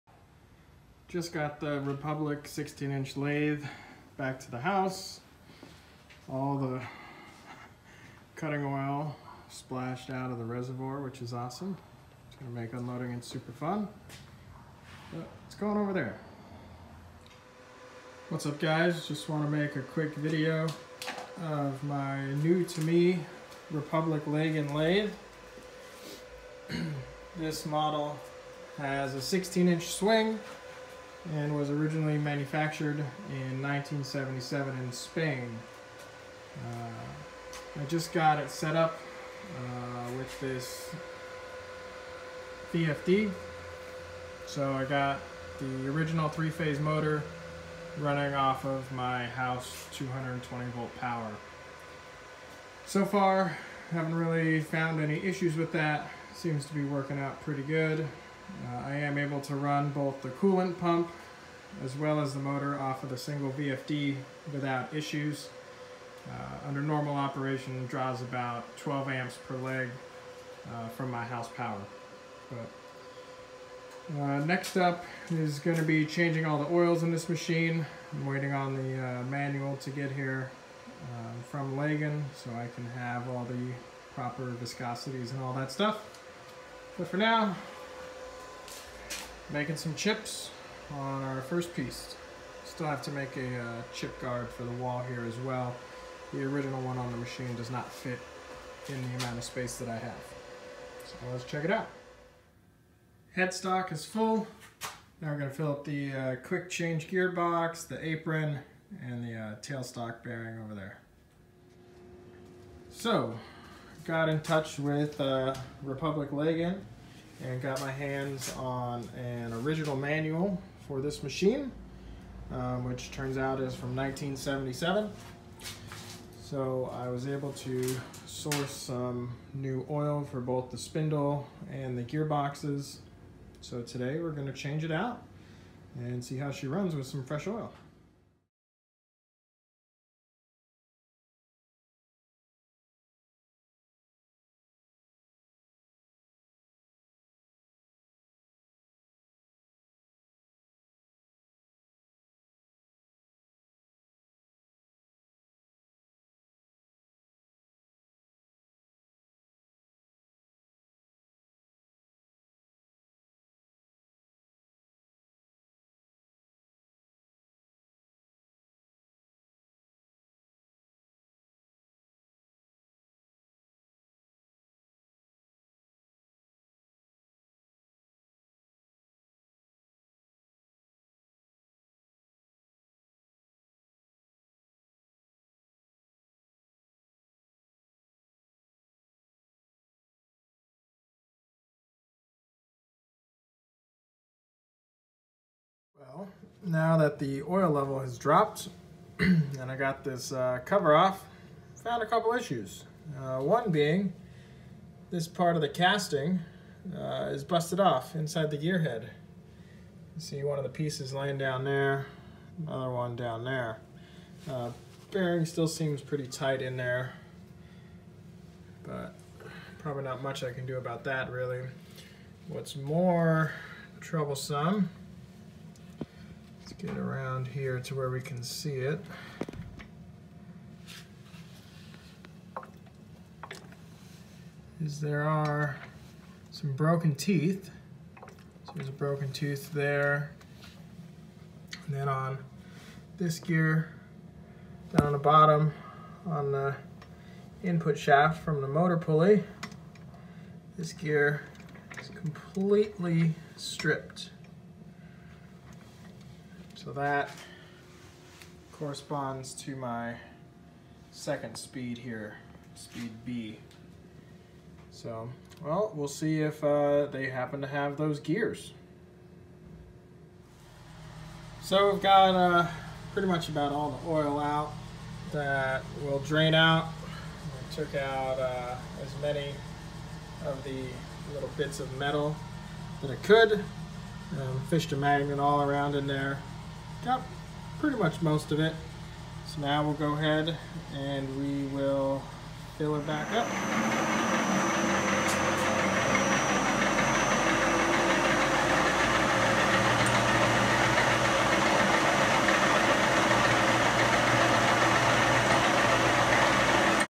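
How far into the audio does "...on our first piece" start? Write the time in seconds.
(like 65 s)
90 s.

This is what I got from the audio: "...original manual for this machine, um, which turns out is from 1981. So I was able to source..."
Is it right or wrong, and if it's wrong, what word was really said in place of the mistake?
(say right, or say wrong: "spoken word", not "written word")
wrong: "1977", not "1981".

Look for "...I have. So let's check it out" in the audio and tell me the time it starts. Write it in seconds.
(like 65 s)
99 s.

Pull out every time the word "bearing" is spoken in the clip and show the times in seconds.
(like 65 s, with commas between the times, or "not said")
110 s, 215 s.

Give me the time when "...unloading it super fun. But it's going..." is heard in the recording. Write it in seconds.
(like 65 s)
12 s.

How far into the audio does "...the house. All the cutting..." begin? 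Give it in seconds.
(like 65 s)
4 s.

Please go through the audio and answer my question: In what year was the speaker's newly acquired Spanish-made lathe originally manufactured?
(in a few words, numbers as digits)
1977.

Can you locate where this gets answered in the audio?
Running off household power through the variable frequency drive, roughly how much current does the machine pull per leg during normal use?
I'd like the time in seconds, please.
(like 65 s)
68 s.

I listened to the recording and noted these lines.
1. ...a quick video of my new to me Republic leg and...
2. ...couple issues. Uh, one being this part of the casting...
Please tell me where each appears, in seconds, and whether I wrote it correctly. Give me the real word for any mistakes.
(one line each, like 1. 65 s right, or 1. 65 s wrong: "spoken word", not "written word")
1. 19 s right
2. 202 s right.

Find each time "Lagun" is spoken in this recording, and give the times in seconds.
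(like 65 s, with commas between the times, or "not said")
81 s, 116 s.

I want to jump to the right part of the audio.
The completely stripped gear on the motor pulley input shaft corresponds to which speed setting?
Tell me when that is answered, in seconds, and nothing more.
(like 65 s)
262 s.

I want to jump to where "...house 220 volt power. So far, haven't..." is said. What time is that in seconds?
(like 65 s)
49 s.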